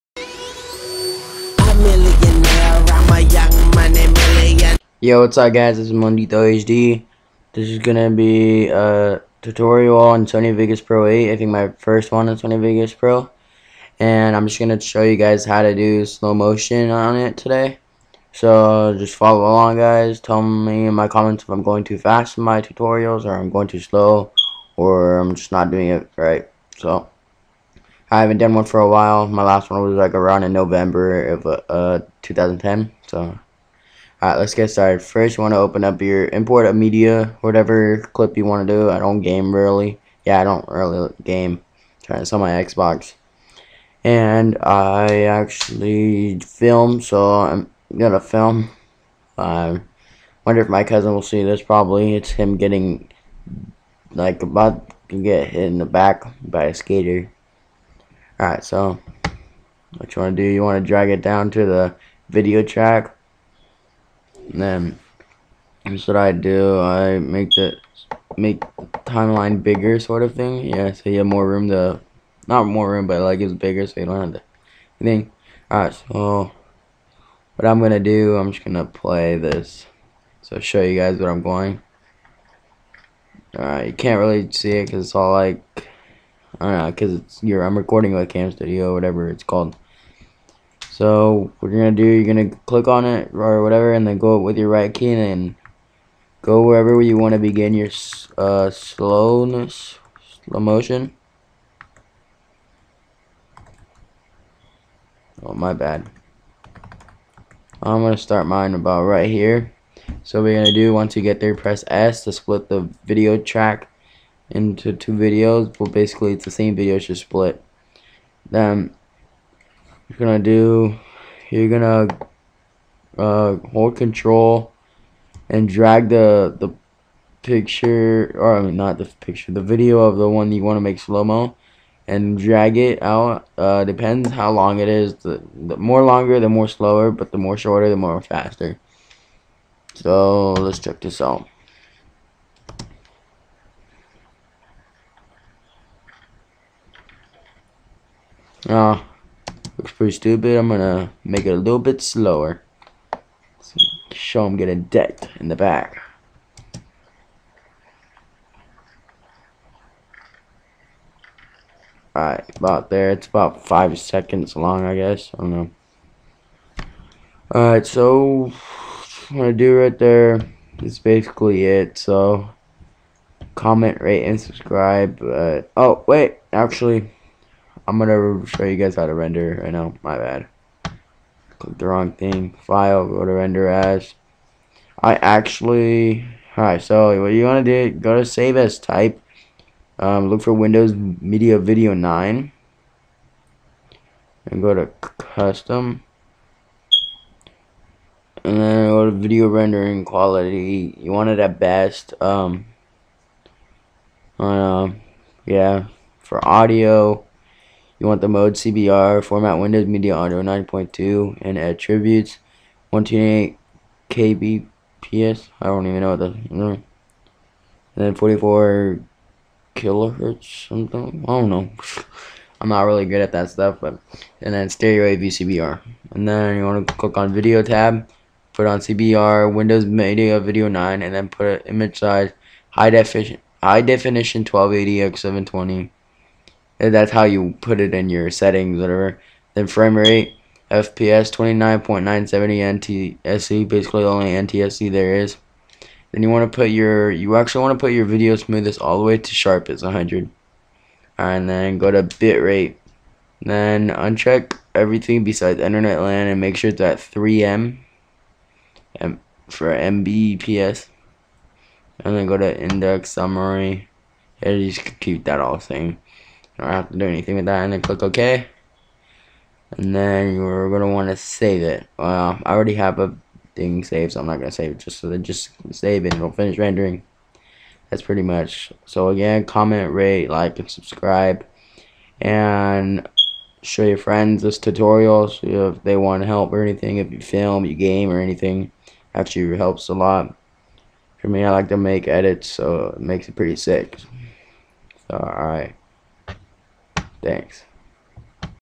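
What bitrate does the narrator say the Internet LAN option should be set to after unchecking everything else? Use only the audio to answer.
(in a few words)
3 Mbps.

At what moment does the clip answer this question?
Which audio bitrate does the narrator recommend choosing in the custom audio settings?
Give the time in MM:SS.
03:32.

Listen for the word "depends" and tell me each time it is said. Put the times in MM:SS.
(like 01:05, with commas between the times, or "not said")
02:13.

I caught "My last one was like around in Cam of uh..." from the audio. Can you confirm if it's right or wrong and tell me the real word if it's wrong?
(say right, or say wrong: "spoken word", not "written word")
wrong: "November", not "Cam".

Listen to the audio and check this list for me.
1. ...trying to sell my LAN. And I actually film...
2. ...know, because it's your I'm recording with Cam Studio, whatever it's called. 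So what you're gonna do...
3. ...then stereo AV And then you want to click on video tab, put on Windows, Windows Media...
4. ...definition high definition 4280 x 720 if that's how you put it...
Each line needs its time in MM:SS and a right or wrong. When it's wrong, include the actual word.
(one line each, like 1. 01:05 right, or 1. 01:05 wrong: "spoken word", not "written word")
1. 00:42 wrong: "Xbox", not "LAN"
2. 01:26 right
3. 03:44 wrong: "CBR", not "Windows"
4. 03:52 wrong: "1280", not "4280".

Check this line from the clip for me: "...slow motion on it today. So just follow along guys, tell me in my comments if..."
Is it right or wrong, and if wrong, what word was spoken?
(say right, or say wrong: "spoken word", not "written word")
right.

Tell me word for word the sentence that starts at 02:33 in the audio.
So show him getting decked in the back.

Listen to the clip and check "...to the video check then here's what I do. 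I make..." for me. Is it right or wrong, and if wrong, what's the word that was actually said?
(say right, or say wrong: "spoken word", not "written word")
wrong: "track", not "check".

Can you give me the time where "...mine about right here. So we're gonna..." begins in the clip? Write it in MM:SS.
01:48.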